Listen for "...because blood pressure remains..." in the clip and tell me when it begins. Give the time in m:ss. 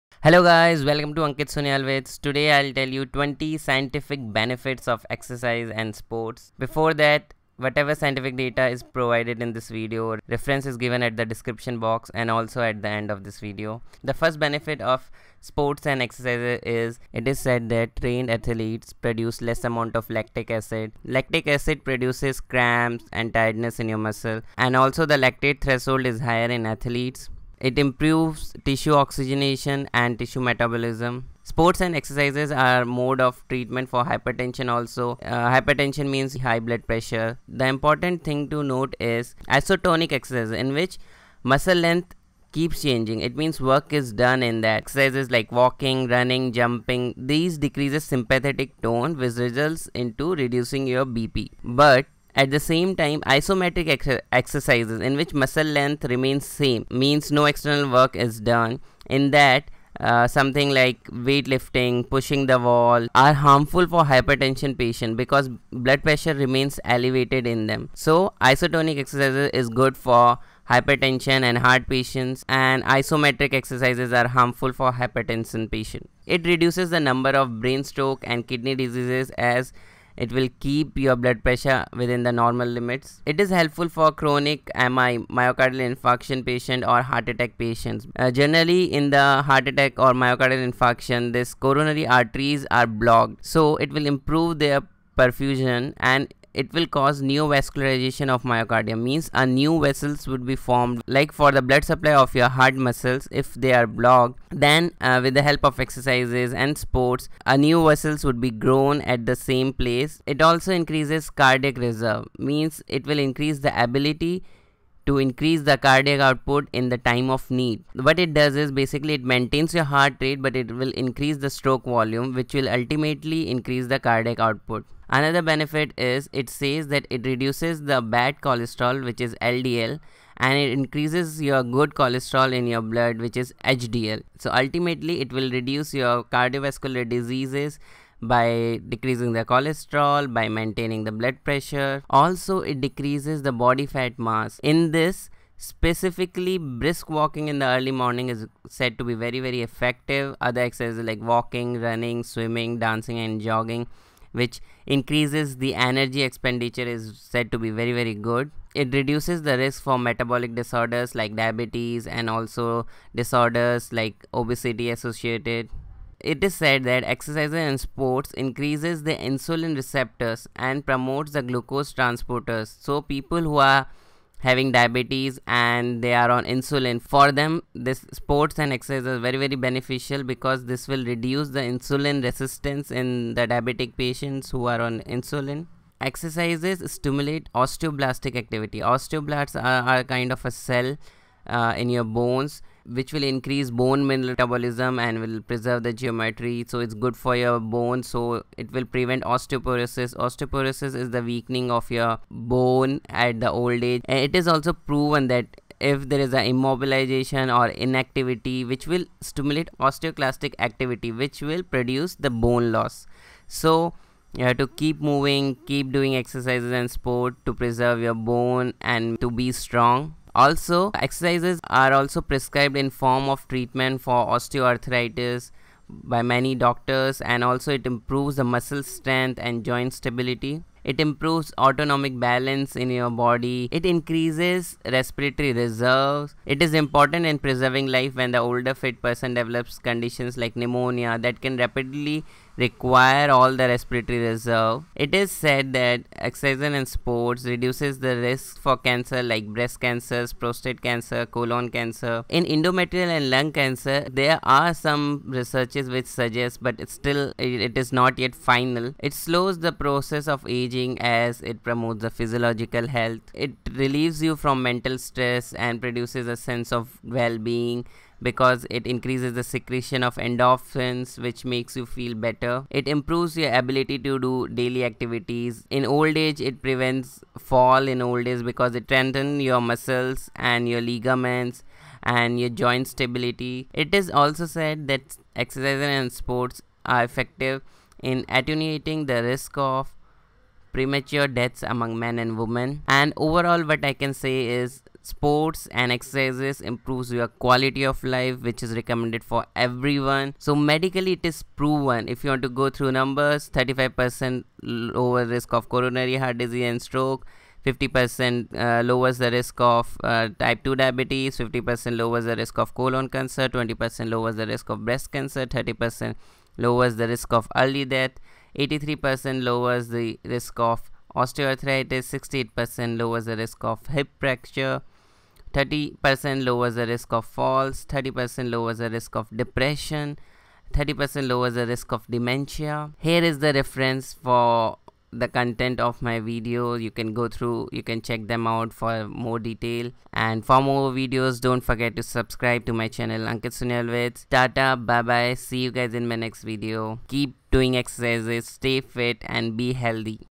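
1:05.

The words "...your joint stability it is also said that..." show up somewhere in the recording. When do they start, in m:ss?
4:42.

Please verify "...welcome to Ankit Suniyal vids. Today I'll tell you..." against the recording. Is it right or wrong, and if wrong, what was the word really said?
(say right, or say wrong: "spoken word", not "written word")
right.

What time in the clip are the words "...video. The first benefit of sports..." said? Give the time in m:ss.
0:13.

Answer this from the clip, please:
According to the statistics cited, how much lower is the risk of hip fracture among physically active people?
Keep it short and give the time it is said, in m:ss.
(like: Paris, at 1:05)
68%, at 5:22.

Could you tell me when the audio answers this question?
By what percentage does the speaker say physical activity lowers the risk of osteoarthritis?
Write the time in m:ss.
5:18.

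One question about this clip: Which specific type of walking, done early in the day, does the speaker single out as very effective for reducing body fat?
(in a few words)
Brisk walking.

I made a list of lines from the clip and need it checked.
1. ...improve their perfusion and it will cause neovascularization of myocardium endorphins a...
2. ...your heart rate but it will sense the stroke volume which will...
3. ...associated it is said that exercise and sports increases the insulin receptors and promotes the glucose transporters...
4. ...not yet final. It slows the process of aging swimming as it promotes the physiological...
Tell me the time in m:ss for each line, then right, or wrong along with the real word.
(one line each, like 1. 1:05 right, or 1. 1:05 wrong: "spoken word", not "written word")
1. 1:34 wrong: "means", not "endorphins"
2. 1:59 wrong: "increase", not "sense"
3. 2:44 right
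4. 4:17 wrong: "aging", not "swimming".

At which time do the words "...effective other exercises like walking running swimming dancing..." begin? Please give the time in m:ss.
2:29.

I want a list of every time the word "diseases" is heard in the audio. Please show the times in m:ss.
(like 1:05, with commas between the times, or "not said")
1:18, 2:17, 5:06.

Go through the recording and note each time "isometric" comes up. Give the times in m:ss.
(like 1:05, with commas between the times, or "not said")
0:53, 1:12.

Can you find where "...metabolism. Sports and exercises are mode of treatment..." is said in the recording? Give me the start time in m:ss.
0:30.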